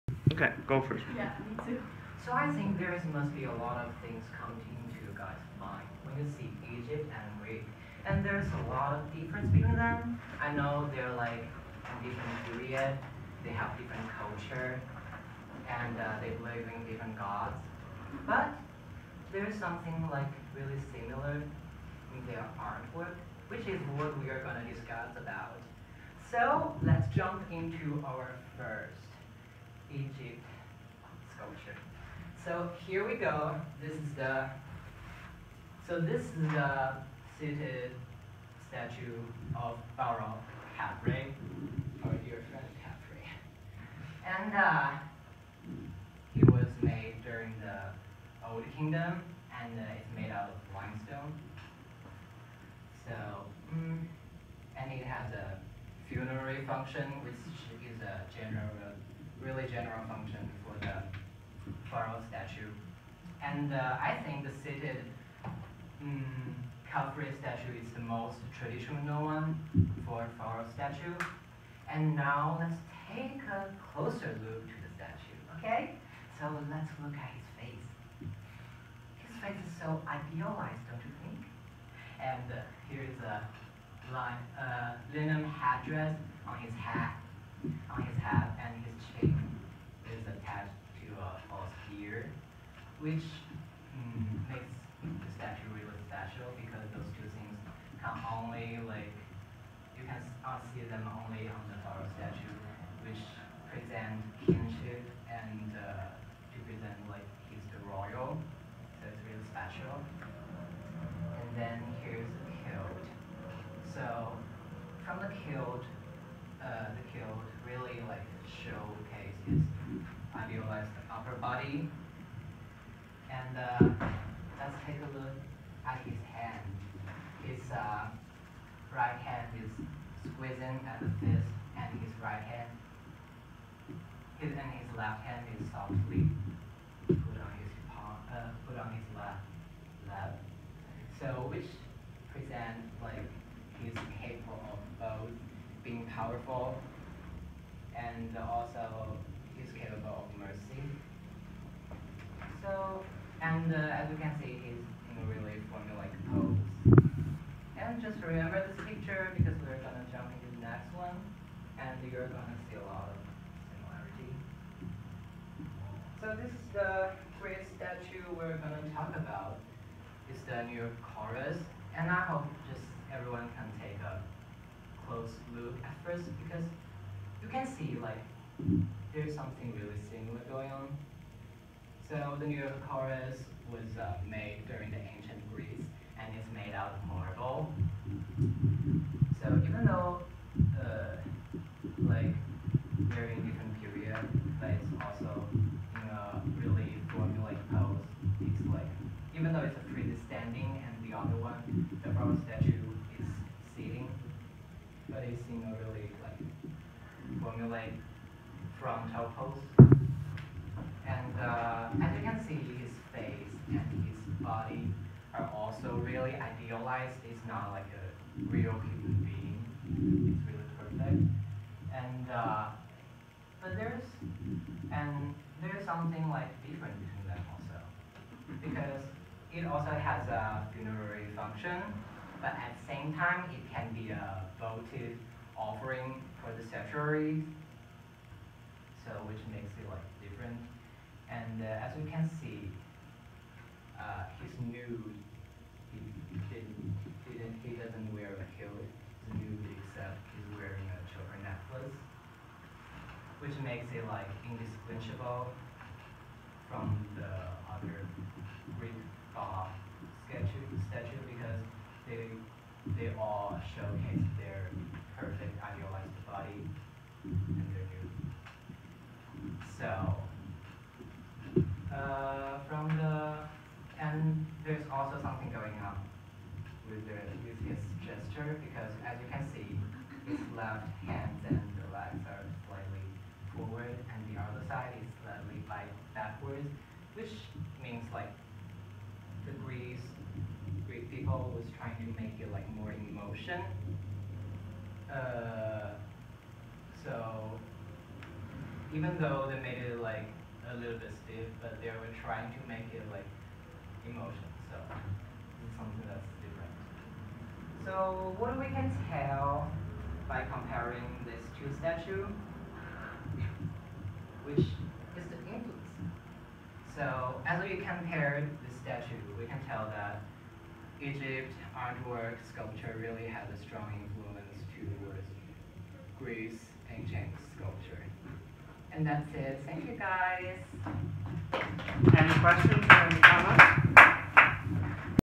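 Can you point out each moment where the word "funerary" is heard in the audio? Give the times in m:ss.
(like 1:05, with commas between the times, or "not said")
0:56, 3:50.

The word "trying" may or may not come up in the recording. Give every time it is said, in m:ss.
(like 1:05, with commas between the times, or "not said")
4:51, 5:02.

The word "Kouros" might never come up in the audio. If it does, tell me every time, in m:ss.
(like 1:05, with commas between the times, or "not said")
2:51, 3:02.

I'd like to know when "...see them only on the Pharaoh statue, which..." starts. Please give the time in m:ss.
1:40.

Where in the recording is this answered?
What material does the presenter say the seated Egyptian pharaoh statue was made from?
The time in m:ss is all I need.
0:50.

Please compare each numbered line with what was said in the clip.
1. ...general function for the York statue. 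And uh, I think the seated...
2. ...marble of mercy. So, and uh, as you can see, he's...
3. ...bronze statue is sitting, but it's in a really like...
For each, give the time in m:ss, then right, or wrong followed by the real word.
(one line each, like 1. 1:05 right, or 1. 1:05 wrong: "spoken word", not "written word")
1. 0:59 wrong: "Pharaoh", not "York"
2. 2:29 wrong: "capable", not "marble"
3. 3:22 right.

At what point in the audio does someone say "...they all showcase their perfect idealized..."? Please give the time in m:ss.
4:22.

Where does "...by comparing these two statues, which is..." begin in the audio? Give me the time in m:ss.
5:10.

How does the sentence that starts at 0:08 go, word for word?
And there's a lot of difference between them.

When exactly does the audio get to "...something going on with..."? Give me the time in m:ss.
4:35.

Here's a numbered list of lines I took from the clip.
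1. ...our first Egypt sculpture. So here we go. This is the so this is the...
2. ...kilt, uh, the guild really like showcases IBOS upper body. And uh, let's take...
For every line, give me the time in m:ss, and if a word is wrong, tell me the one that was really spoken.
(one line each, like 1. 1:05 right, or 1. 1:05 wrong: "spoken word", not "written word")
1. 0:28 right
2. 1:55 right.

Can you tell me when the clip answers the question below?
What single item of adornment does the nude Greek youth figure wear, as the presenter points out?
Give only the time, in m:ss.
4:11.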